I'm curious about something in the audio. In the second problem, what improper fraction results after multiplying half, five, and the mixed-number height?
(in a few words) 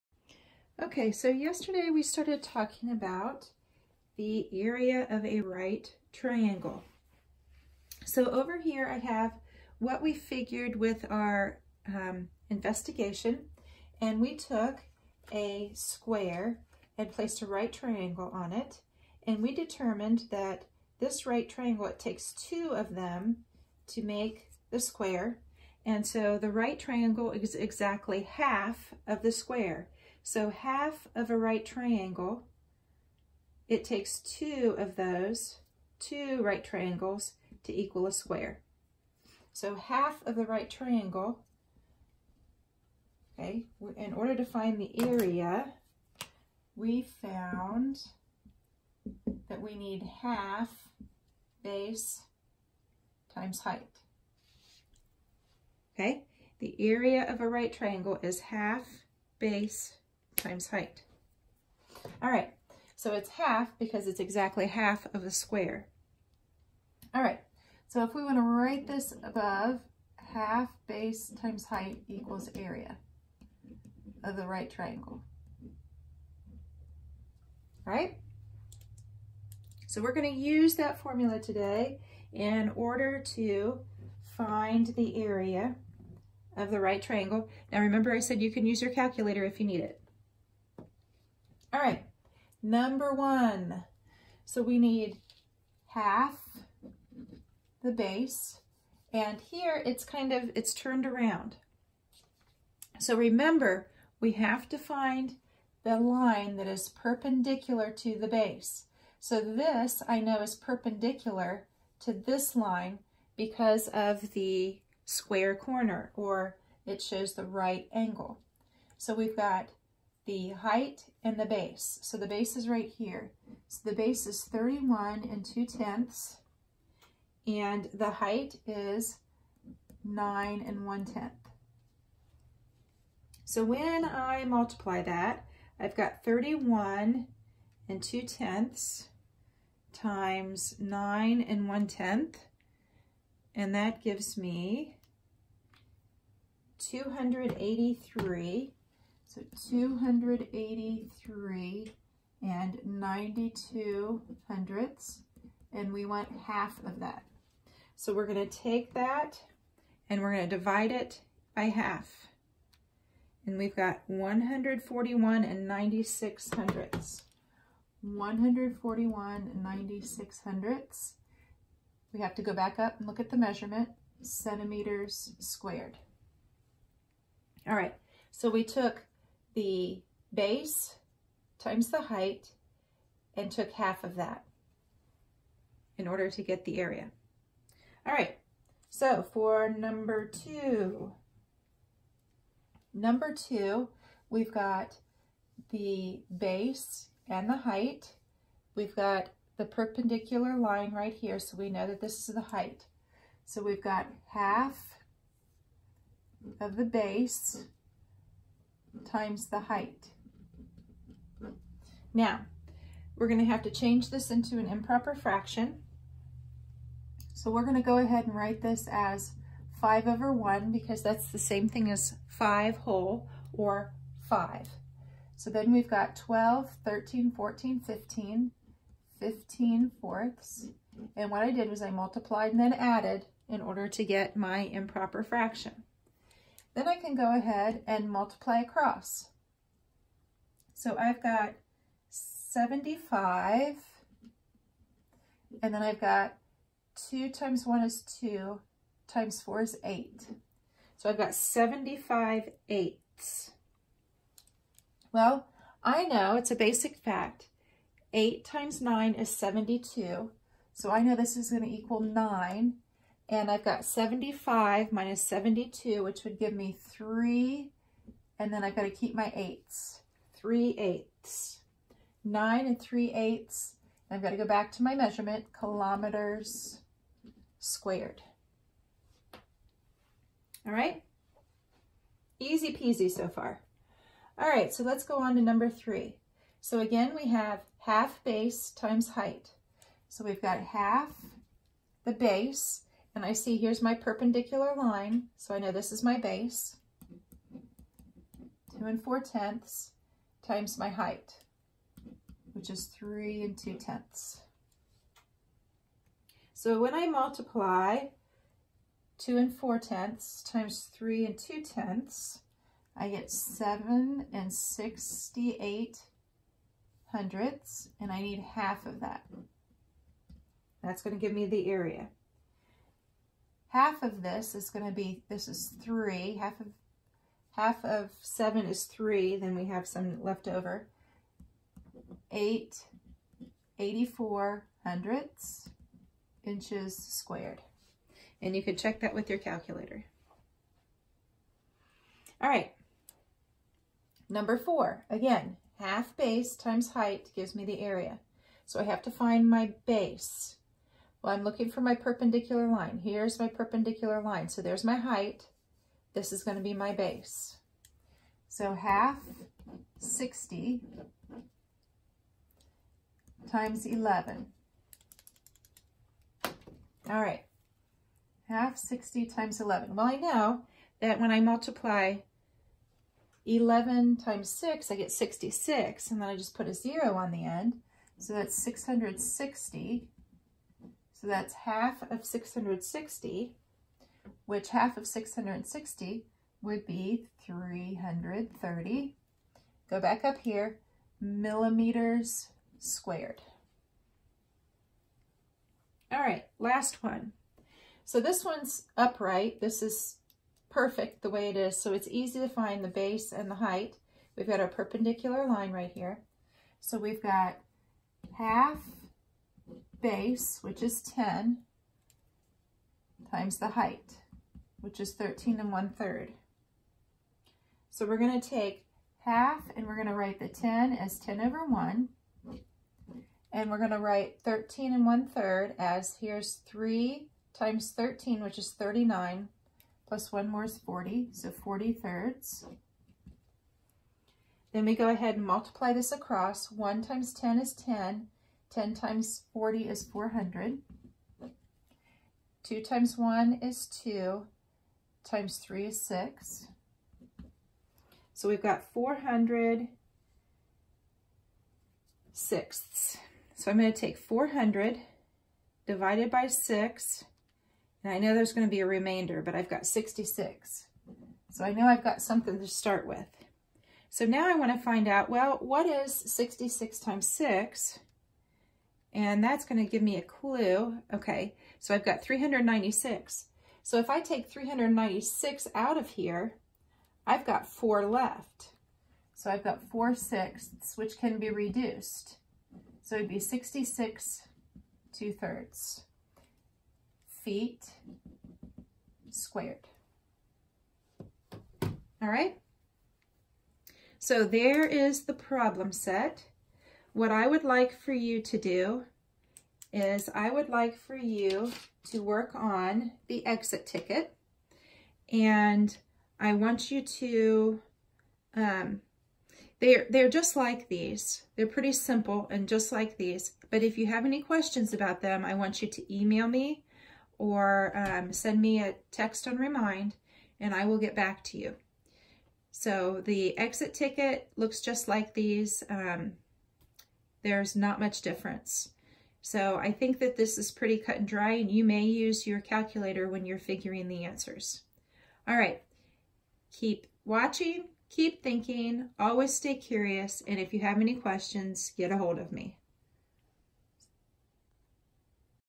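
75/8.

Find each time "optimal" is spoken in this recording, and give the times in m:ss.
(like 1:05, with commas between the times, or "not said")
not said.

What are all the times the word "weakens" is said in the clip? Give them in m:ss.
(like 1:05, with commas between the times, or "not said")
not said.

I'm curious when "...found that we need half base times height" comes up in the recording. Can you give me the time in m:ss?
0:47.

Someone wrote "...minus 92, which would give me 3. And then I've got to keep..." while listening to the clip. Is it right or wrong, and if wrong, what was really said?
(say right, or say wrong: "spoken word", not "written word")
wrong: "72", not "92".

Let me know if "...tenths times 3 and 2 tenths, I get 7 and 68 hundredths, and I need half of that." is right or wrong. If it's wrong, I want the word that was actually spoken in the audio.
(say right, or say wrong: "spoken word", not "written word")
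right.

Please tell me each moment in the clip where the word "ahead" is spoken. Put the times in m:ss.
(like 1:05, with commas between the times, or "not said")
3:37, 3:57, 7:15.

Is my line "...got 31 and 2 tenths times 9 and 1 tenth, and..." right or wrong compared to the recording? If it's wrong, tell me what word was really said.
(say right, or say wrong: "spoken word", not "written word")
right.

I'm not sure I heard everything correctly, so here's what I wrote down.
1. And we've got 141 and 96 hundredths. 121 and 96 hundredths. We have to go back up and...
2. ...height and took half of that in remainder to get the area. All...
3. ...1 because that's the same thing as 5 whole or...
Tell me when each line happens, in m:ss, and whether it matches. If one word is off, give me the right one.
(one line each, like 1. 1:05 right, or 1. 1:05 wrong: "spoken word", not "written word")
1. 2:43 wrong: "141", not "121"
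2. 3:02 wrong: "order", not "remainder"
3. 3:40 right.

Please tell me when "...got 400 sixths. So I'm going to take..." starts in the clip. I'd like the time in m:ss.
7:28.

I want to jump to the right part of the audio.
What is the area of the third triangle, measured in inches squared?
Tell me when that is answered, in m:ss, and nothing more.
5:33.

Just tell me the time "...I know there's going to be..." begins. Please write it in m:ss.
7:38.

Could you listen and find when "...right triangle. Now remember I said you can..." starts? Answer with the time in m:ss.
1:26.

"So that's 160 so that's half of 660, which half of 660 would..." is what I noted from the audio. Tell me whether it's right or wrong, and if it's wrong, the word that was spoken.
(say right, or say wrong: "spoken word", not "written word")
wrong: "660", not "160".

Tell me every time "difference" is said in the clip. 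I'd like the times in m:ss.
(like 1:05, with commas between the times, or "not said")
8:48.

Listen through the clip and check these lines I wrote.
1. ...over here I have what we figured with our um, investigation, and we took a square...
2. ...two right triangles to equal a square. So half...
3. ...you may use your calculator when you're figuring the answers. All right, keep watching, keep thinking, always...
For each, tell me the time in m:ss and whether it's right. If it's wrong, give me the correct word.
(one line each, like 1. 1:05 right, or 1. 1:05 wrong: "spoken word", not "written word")
1. 0:08 right
2. 0:35 right
3. 8:51 right.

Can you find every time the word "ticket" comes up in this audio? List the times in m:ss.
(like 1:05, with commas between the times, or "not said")
8:23, 8:43.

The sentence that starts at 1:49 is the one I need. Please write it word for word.
So this I know is perpendicular to this line because of the square corner or it shows the right angle.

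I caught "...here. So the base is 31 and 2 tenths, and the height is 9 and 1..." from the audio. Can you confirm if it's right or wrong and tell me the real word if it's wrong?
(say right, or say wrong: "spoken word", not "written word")
right.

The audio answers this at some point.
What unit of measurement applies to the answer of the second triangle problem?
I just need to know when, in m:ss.
4:35.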